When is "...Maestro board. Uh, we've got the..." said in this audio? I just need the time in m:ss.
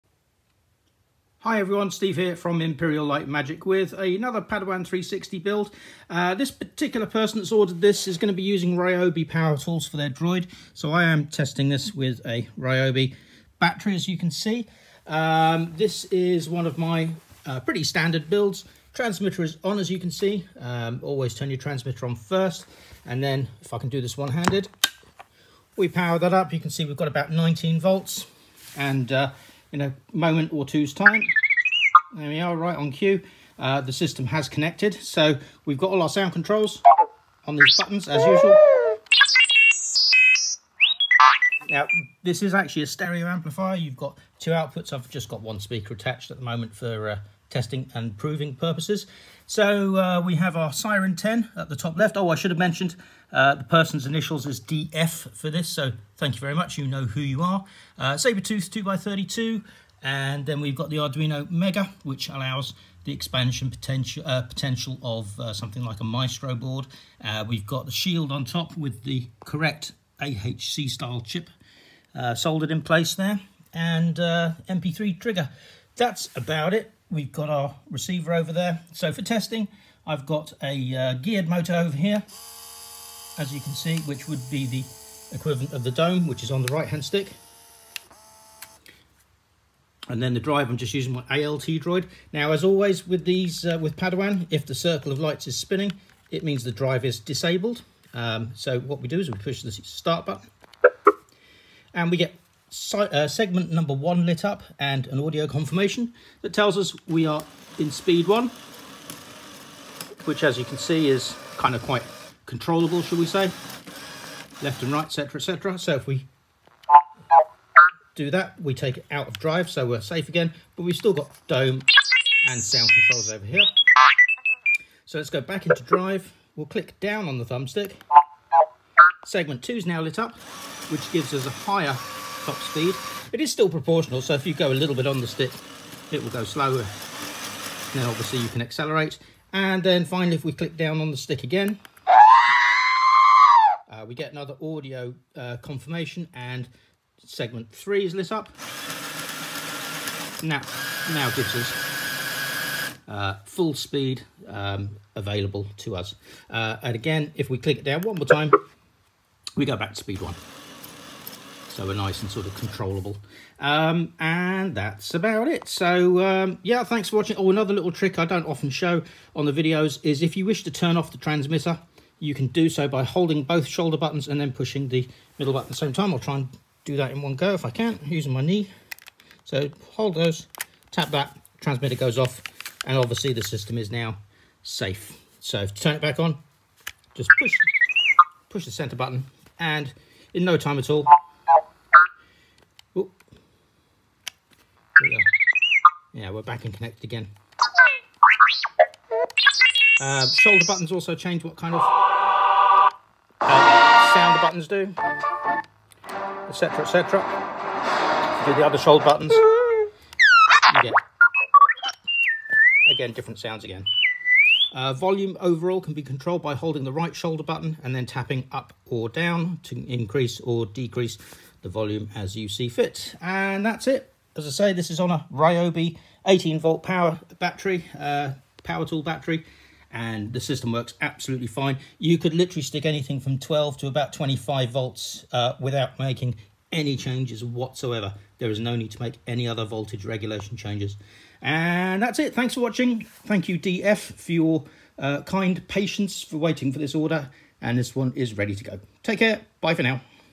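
1:06.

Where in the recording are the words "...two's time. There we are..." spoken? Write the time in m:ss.
0:30.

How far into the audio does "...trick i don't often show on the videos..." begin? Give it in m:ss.
2:47.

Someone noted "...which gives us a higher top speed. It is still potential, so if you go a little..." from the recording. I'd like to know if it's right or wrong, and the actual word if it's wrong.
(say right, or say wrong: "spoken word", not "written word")
wrong: "proportional", not "potential".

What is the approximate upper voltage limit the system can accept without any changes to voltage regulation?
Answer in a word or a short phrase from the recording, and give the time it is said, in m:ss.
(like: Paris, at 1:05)
25 volts, at 3:54.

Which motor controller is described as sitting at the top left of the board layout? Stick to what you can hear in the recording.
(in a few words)
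Syren 10.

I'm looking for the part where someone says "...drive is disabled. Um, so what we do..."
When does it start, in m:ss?
1:36.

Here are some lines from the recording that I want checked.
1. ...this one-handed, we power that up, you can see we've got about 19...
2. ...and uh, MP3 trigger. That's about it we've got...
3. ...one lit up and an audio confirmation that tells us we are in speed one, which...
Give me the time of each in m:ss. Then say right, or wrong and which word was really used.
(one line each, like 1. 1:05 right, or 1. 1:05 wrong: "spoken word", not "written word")
1. 0:23 right
2. 1:13 right
3. 1:43 right.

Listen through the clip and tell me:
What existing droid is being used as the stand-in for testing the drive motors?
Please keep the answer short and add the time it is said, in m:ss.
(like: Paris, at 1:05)
ALT droid, at 1:31.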